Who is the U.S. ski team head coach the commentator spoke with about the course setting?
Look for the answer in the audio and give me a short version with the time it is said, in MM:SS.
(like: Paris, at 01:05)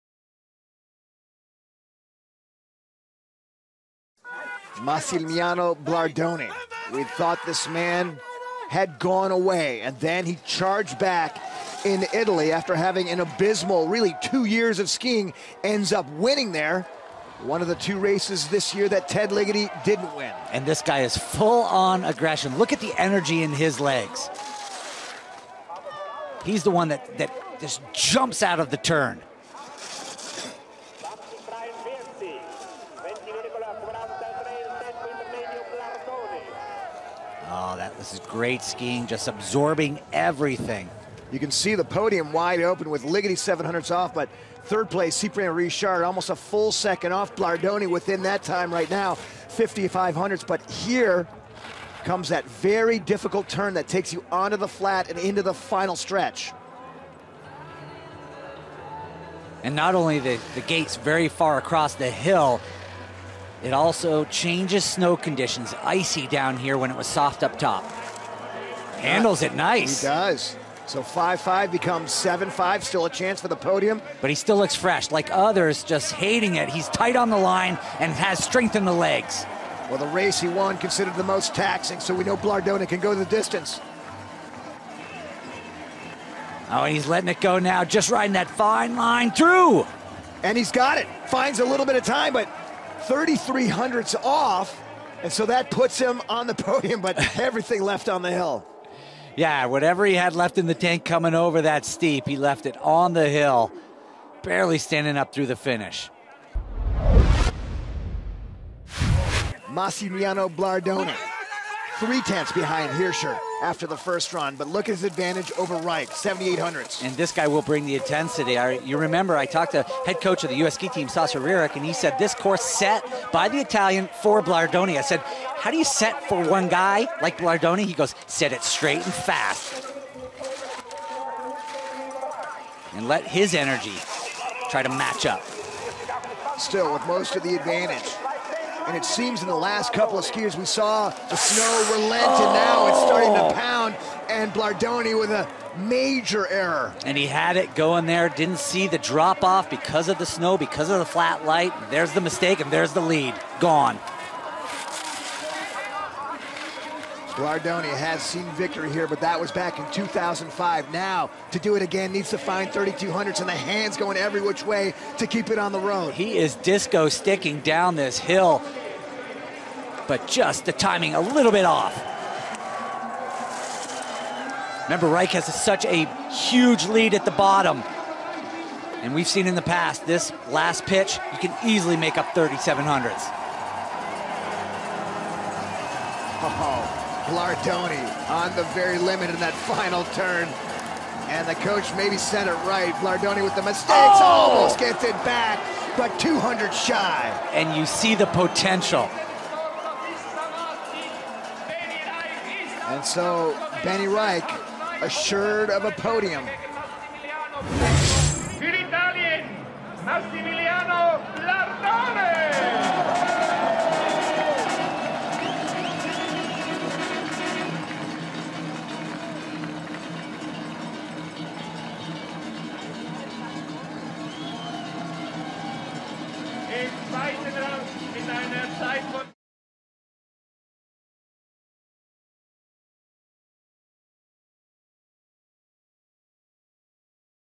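Sasha Rearick, at 02:01.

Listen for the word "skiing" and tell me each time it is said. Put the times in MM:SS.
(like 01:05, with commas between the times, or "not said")
00:14, 00:38.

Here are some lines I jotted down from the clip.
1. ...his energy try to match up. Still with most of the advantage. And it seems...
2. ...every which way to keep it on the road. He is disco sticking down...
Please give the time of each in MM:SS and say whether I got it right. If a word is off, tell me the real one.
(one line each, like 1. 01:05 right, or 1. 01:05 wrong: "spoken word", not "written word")
1. 02:13 right
2. 02:44 right.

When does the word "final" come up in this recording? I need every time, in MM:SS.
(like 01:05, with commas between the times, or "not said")
00:55, 03:09.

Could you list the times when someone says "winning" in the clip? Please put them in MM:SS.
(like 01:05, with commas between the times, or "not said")
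00:16.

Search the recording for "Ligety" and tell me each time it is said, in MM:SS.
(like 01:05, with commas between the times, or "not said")
00:19, 00:43.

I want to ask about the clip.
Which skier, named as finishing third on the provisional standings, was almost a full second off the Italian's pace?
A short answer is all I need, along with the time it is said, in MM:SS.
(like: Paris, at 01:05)
Cyprien Richard, at 00:45.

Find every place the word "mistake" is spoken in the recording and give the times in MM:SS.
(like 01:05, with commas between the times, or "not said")
02:32, 03:13.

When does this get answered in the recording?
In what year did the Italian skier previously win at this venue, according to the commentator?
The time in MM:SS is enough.
02:39.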